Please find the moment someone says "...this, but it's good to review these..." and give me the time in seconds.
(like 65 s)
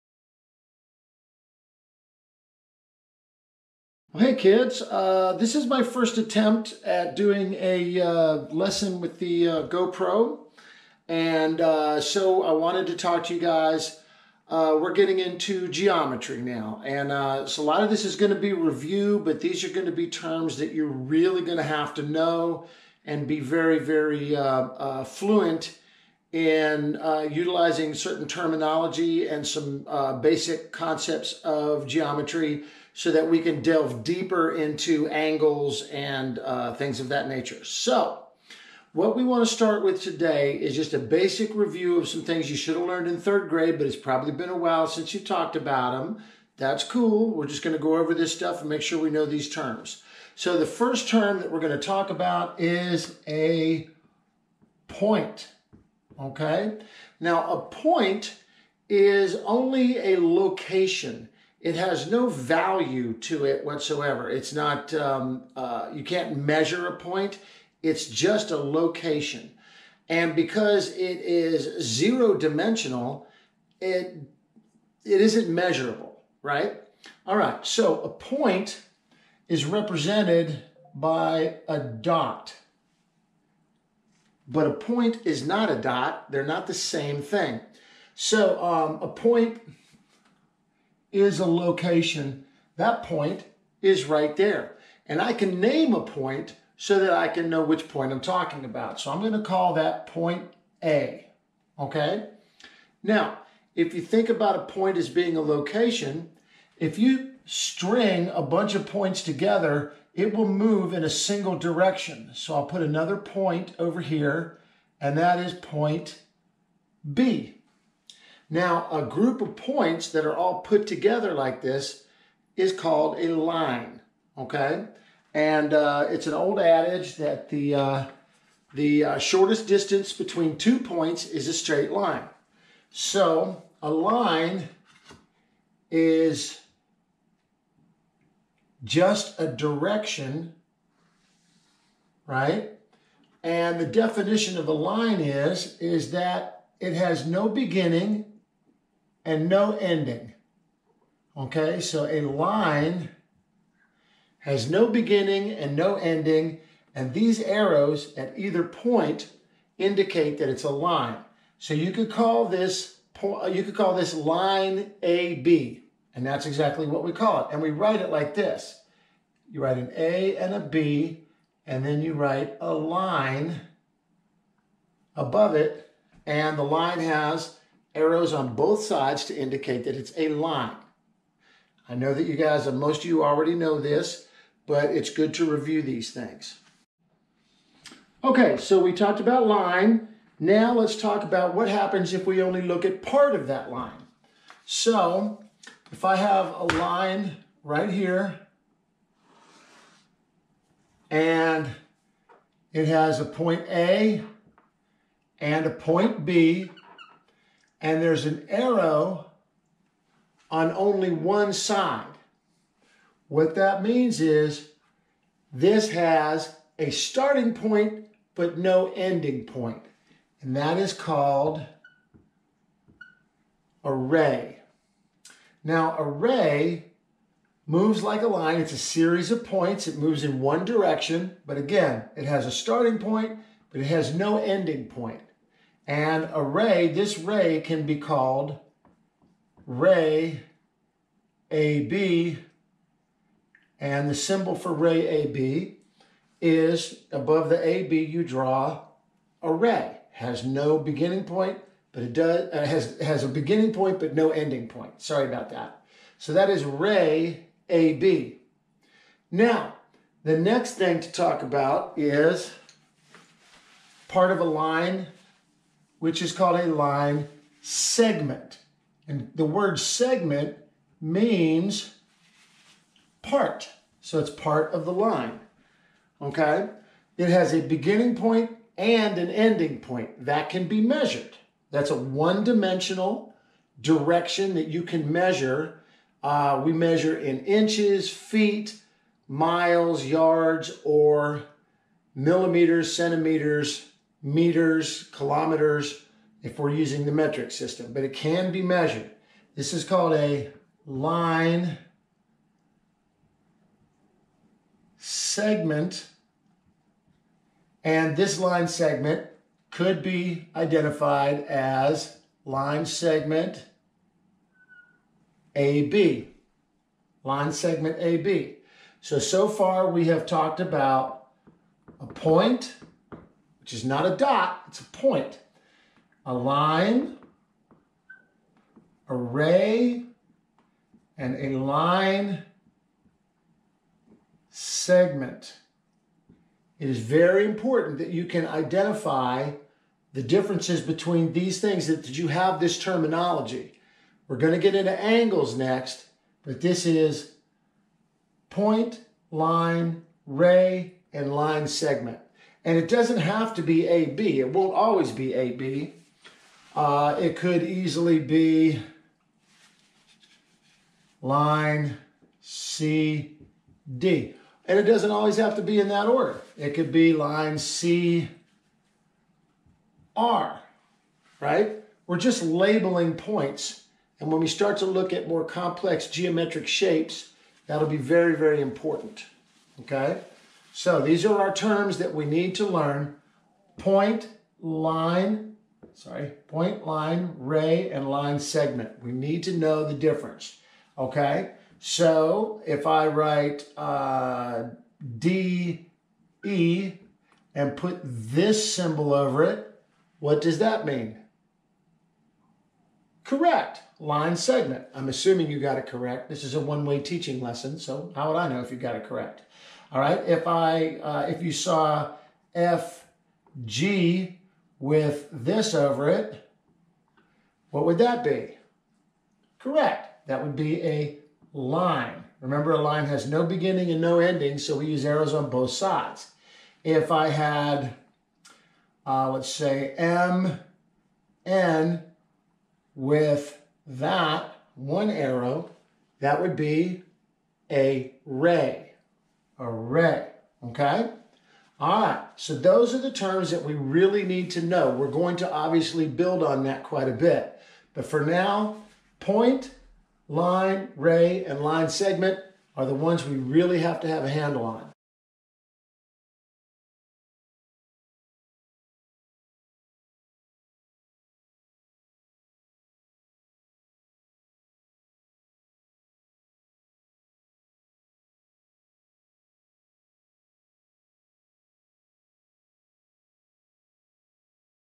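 183 s.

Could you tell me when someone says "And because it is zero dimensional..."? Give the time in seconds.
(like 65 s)
70 s.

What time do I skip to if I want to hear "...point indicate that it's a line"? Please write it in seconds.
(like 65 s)
158 s.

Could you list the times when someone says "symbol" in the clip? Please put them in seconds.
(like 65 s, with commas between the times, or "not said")
244 s, 398 s.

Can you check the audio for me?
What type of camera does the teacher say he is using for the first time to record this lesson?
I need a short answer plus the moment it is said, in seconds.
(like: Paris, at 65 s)
GoPro, at 9 s.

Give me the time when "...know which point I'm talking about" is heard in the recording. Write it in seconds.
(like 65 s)
97 s.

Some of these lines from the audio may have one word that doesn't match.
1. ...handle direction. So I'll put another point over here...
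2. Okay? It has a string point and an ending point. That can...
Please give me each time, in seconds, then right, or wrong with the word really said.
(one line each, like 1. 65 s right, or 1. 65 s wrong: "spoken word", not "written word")
1. 111 s wrong: "single", not "handle"
2. 276 s wrong: "beginning", not "string".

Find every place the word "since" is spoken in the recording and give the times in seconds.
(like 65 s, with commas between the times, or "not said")
44 s.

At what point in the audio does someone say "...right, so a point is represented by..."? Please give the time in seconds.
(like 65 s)
77 s.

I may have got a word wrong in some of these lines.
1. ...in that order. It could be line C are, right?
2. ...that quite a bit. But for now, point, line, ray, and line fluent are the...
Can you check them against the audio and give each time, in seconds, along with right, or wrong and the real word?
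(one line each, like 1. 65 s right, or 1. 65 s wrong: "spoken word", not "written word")
1. 365 s right
2. 446 s wrong: "segment", not "fluent".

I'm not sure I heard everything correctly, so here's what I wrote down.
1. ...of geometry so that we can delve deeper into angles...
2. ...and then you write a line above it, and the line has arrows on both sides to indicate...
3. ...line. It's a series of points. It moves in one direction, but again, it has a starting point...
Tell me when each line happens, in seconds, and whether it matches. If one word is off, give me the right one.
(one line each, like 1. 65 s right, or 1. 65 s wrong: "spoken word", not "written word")
1. 31 s right
2. 171 s right
3. 228 s right.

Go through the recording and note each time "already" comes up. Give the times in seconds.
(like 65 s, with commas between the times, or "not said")
183 s.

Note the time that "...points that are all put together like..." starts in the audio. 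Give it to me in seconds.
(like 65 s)
119 s.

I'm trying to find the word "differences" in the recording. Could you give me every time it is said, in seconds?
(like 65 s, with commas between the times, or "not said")
340 s, 389 s.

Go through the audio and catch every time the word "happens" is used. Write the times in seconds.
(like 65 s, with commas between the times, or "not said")
191 s.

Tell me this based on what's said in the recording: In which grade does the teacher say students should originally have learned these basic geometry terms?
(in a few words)
third grade.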